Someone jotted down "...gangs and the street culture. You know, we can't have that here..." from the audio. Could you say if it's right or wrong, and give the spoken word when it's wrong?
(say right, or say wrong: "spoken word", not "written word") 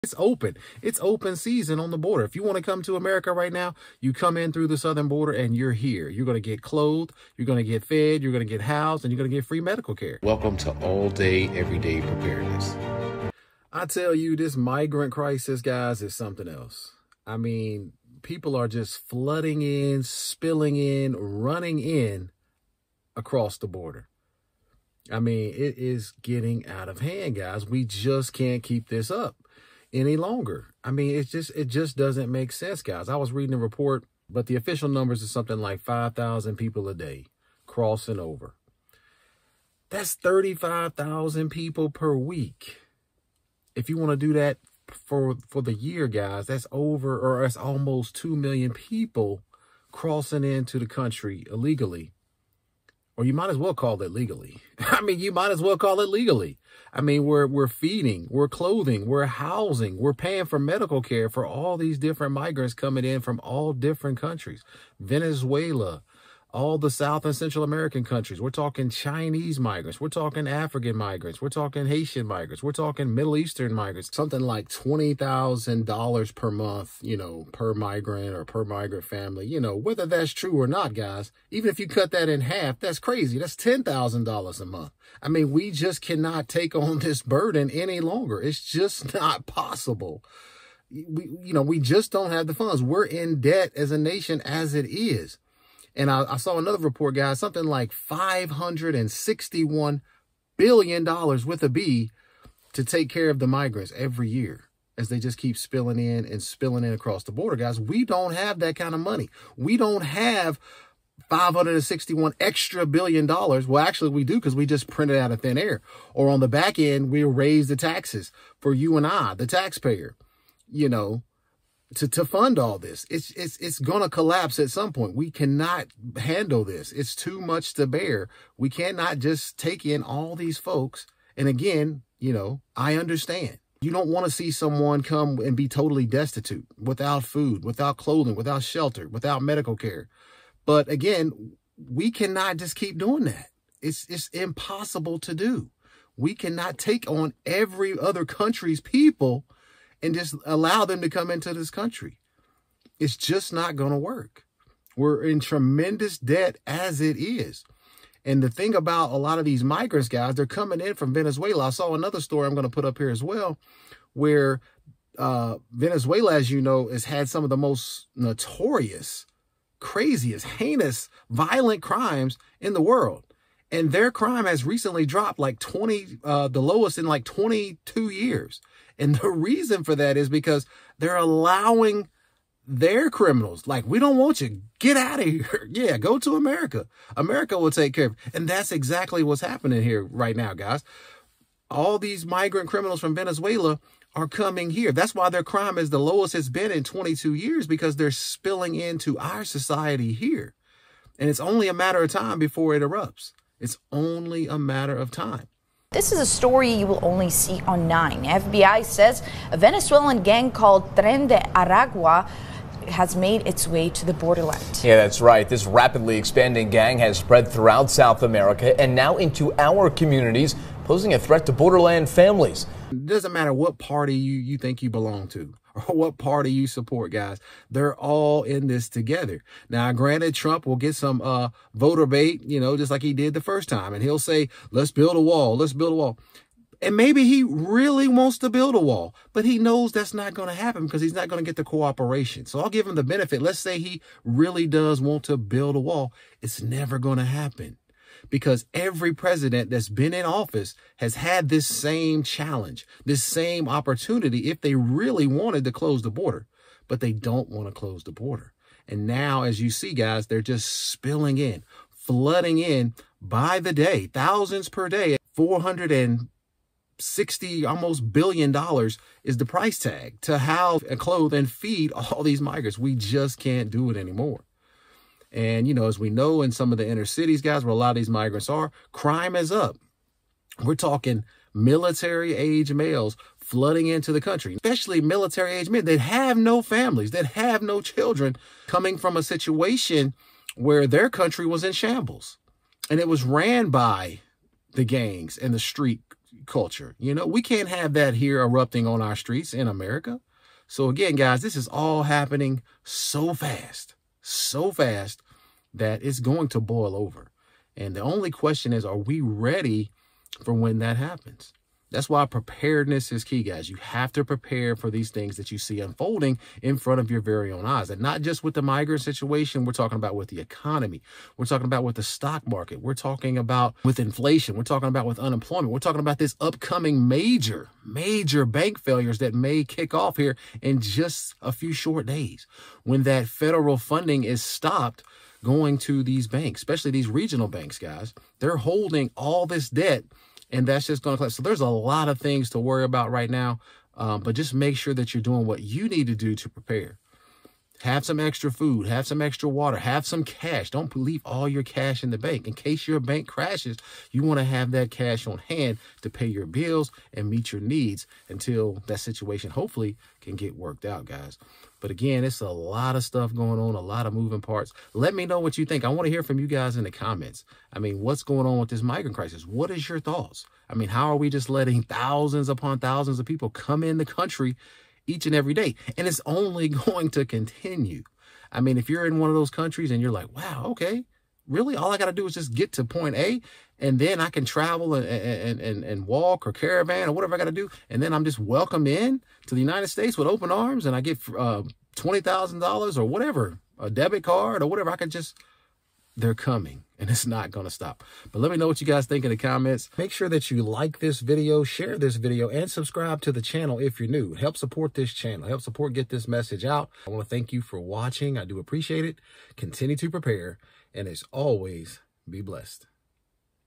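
right.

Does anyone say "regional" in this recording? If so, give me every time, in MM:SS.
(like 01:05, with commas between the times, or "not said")
05:37.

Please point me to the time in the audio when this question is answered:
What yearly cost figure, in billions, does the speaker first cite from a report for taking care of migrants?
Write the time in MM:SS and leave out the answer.
01:37.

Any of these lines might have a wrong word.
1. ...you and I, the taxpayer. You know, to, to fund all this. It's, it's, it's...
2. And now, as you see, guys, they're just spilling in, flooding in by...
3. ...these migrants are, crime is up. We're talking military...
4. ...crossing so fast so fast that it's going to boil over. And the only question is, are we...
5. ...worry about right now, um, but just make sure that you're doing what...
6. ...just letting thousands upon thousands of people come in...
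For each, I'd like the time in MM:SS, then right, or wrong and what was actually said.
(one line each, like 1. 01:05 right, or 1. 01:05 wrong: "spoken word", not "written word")
1. 01:58 right
2. 04:18 right
3. 04:37 right
4. 05:02 wrong: "happening", not "crossing"
5. 05:42 right
6. 06:11 right.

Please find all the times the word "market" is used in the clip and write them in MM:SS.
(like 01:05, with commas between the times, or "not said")
05:22.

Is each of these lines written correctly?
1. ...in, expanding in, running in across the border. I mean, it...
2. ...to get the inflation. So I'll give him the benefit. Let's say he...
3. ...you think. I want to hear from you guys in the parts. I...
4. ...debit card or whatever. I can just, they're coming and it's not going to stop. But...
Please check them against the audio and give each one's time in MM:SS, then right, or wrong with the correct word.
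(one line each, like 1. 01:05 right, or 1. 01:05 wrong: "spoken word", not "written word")
1. 00:19 wrong: "spilling", not "expanding"
2. 04:01 wrong: "cooperation", not "inflation"
3. 06:05 wrong: "comments", not "parts"
4. 06:33 right.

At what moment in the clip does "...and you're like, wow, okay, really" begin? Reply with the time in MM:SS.
06:19.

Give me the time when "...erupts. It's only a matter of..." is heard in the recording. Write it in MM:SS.
03:22.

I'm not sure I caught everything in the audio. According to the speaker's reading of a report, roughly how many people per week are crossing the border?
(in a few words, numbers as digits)
35,000.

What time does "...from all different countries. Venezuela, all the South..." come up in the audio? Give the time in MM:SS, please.
01:03.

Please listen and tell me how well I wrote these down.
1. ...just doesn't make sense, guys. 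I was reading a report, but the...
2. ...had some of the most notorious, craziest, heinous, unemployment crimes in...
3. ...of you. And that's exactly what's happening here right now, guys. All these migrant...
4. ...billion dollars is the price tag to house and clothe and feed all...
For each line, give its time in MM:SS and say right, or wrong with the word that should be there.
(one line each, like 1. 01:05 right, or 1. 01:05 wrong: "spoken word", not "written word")
1. 00:31 right
2. 02:47 wrong: "violent", not "unemployment"
3. 03:08 right
4. 04:28 right.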